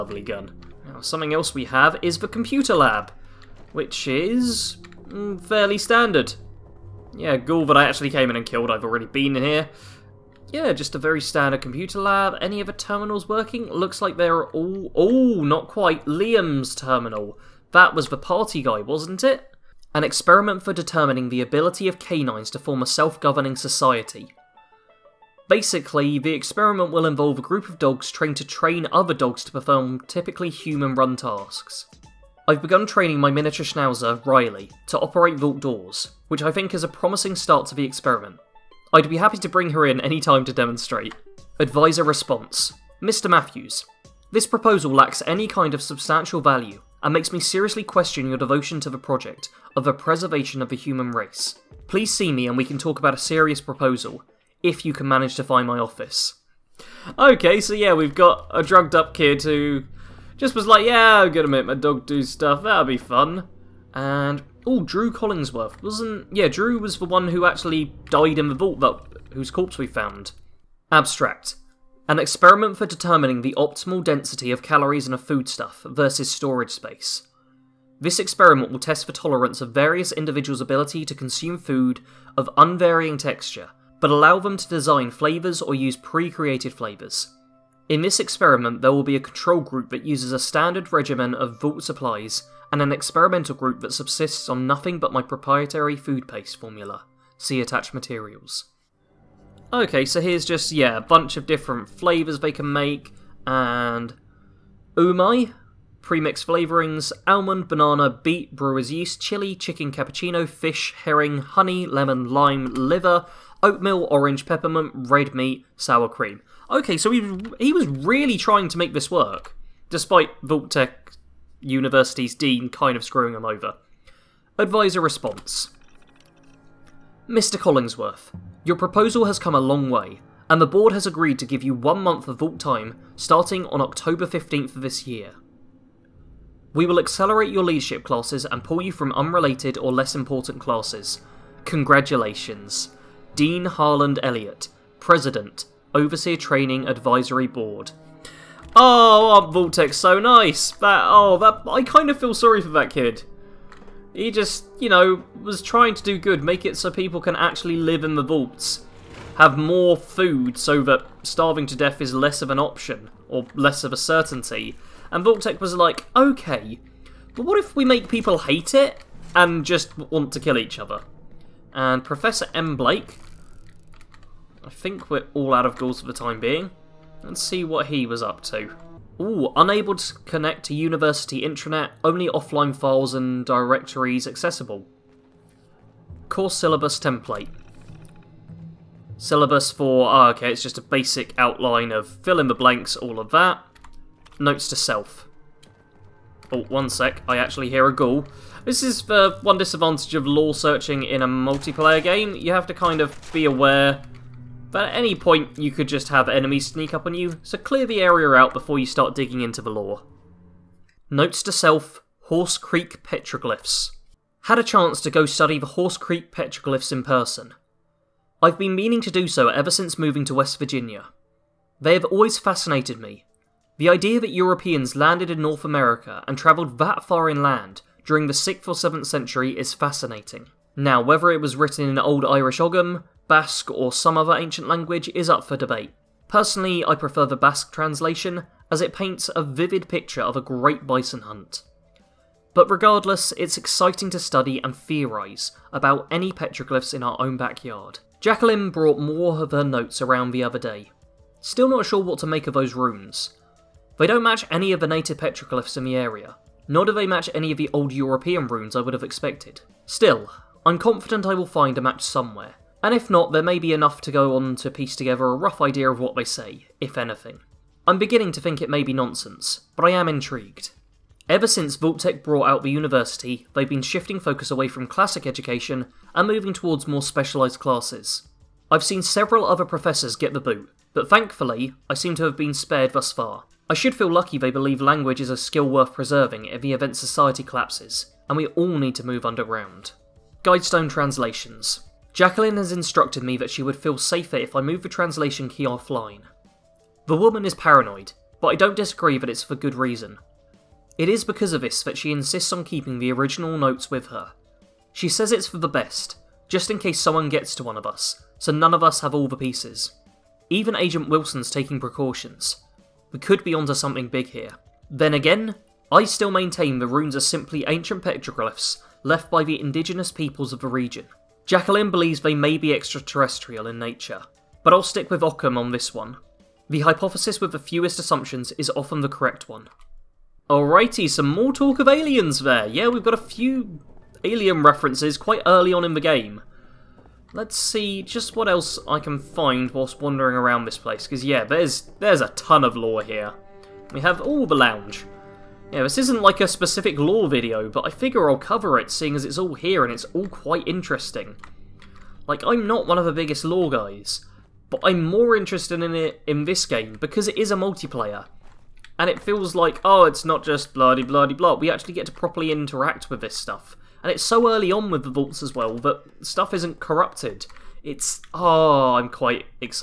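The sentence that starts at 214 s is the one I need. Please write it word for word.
Had a chance to go study the Horse Creek petroglyphs in person.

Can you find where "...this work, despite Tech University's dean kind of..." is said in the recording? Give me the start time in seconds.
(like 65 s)
118 s.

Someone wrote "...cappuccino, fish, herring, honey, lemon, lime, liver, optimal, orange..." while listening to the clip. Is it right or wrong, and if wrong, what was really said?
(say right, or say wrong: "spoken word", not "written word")
wrong: "oatmeal", not "optimal".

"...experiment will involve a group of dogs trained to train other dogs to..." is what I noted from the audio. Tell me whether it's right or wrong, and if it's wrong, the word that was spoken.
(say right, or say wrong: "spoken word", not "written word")
right.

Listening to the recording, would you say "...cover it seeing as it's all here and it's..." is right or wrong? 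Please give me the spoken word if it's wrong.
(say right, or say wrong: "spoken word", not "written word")
right.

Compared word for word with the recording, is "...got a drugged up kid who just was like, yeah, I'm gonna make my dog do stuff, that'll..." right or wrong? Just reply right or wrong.
right.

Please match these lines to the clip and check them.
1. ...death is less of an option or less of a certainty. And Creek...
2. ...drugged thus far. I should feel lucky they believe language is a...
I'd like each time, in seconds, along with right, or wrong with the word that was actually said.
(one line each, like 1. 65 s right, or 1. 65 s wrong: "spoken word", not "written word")
1. 161 s wrong: "Vault", not "Creek"
2. 282 s wrong: "spared", not "drugged".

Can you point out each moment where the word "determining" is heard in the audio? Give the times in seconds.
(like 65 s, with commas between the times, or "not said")
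20 s, 72 s.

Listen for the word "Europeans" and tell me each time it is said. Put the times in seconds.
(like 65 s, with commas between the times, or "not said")
224 s, 257 s.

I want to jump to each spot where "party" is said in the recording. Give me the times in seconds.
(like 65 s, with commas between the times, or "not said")
18 s.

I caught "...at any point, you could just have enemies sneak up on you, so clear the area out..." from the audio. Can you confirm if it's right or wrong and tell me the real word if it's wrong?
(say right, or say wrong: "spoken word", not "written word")
right.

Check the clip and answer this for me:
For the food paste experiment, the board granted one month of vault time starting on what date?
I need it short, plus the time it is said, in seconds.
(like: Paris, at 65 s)
October 15th, at 133 s.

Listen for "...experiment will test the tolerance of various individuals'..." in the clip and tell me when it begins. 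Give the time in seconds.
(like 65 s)
78 s.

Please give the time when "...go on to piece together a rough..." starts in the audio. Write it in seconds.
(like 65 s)
264 s.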